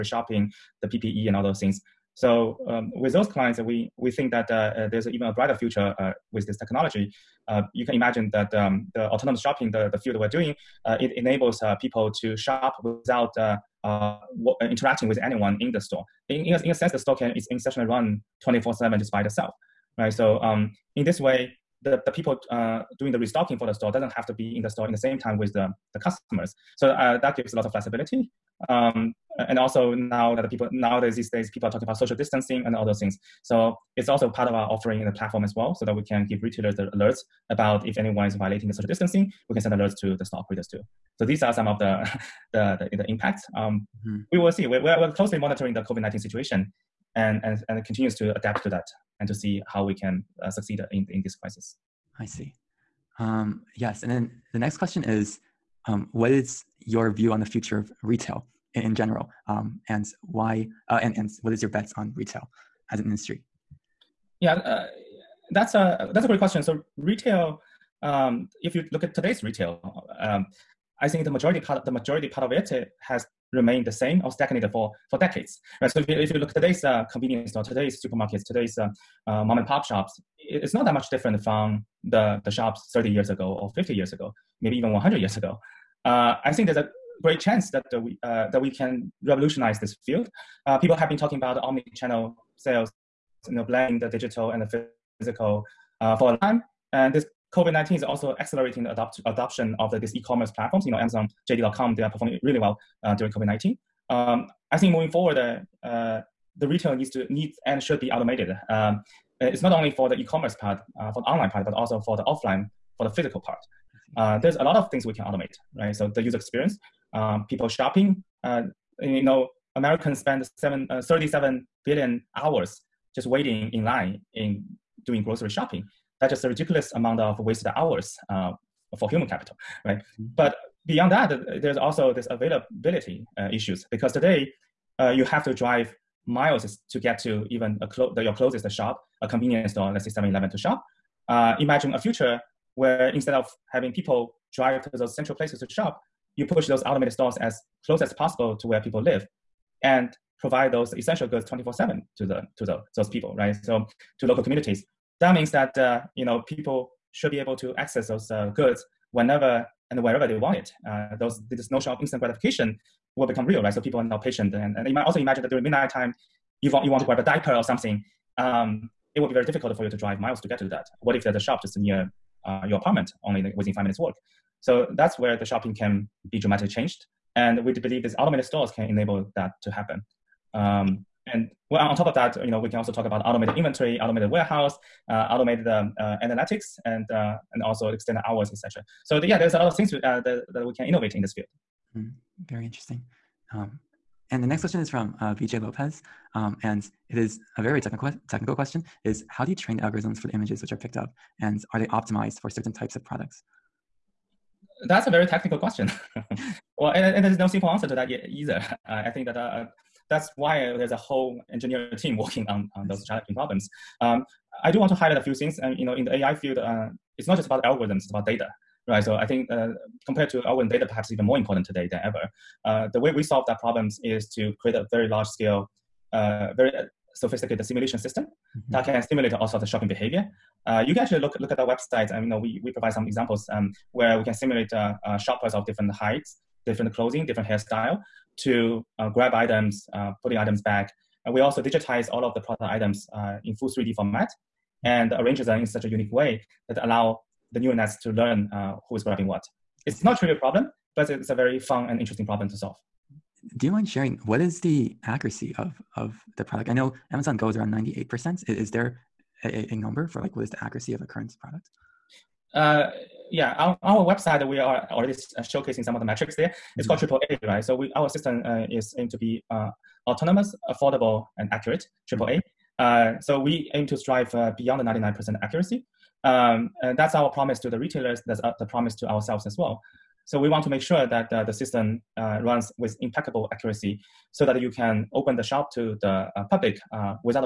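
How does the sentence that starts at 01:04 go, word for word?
Yeah, uh, that's, a, that's a great question.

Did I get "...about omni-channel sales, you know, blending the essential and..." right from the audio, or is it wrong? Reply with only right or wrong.
wrong.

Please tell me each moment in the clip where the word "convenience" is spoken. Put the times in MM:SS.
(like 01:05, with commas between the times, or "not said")
01:17, 02:19.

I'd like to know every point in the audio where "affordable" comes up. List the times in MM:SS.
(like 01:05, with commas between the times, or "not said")
04:30.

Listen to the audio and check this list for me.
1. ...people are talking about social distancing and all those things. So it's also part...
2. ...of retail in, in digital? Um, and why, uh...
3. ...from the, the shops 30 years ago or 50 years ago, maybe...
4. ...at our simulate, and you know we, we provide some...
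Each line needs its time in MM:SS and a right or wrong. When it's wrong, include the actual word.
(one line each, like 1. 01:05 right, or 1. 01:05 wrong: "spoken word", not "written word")
1. 00:31 right
2. 00:57 wrong: "general", not "digital"
3. 01:21 right
4. 03:51 wrong: "website", not "simulate".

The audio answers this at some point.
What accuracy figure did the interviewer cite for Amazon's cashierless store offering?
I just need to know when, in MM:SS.
04:17.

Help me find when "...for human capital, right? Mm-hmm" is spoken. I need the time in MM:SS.
02:08.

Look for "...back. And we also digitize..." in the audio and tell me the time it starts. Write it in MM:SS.
04:00.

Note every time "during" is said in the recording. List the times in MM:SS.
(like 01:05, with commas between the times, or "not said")
01:43, 02:45.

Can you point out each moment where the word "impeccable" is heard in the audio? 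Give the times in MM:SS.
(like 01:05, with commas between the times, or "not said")
04:43.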